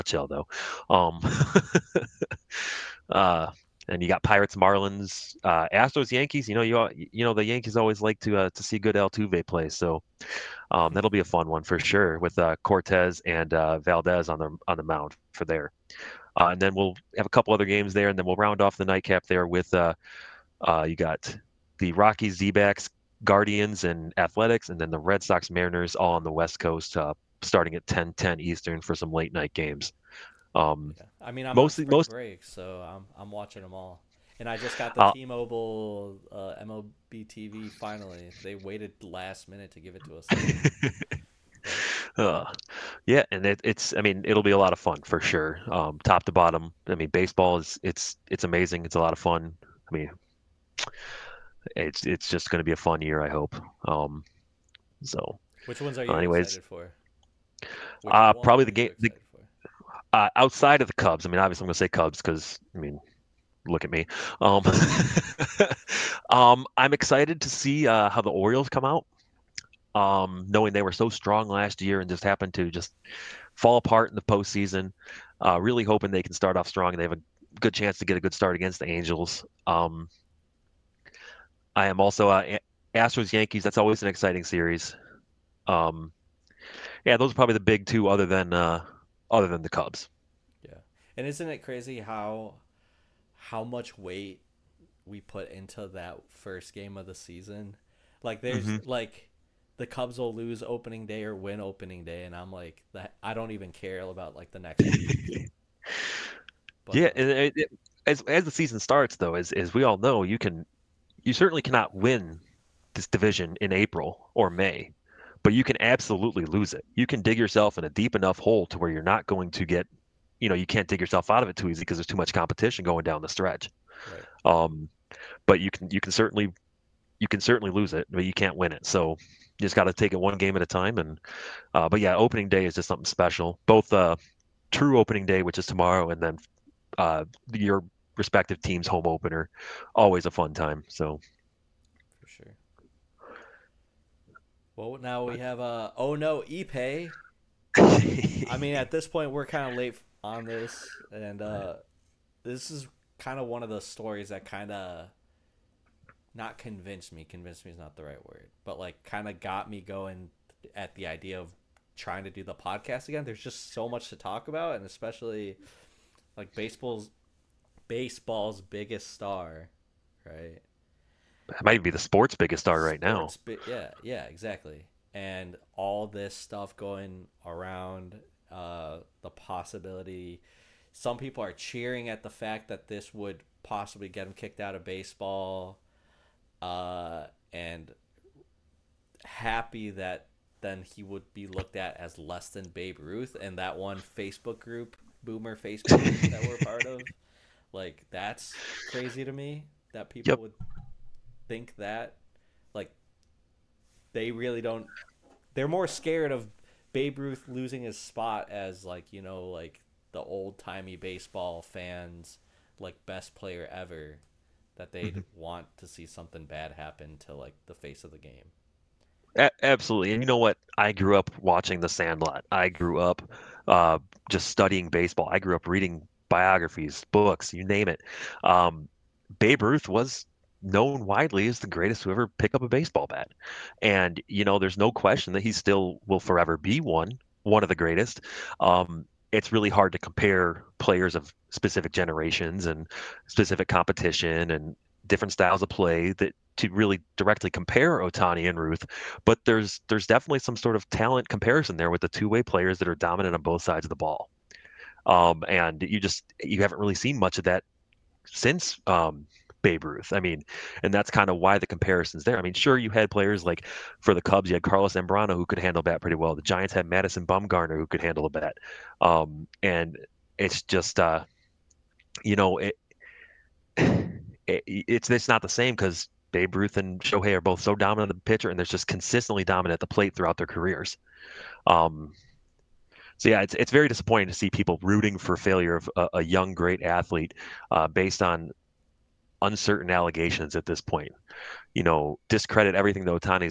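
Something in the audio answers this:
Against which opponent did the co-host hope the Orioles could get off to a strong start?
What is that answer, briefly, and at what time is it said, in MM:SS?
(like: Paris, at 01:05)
Angels, at 01:18.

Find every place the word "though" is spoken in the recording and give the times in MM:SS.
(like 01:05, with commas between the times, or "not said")
00:00, 01:49.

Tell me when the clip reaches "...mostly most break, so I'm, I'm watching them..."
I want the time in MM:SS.
00:31.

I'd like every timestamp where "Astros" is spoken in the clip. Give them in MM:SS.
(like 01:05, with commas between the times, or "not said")
00:05, 01:22.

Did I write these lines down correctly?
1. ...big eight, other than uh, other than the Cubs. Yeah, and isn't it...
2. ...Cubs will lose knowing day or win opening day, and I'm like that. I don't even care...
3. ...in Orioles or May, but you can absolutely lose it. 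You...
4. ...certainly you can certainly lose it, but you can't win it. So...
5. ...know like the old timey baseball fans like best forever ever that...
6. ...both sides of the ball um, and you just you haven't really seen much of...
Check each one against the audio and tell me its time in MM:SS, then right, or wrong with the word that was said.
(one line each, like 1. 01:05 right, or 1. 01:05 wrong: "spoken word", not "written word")
1. 01:27 wrong: "two", not "eight"
2. 01:39 wrong: "opening", not "knowing"
3. 01:53 wrong: "April", not "Orioles"
4. 02:06 right
5. 03:29 wrong: "player", not "forever"
6. 04:13 right.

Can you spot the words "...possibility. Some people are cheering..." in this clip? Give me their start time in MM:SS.
02:59.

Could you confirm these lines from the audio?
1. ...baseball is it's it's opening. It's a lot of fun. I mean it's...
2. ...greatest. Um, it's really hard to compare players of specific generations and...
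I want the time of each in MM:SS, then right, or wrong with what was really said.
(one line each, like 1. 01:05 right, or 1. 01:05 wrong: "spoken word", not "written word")
1. 00:47 wrong: "amazing", not "opening"
2. 03:57 right.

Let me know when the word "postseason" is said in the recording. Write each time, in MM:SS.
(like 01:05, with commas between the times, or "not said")
01:14.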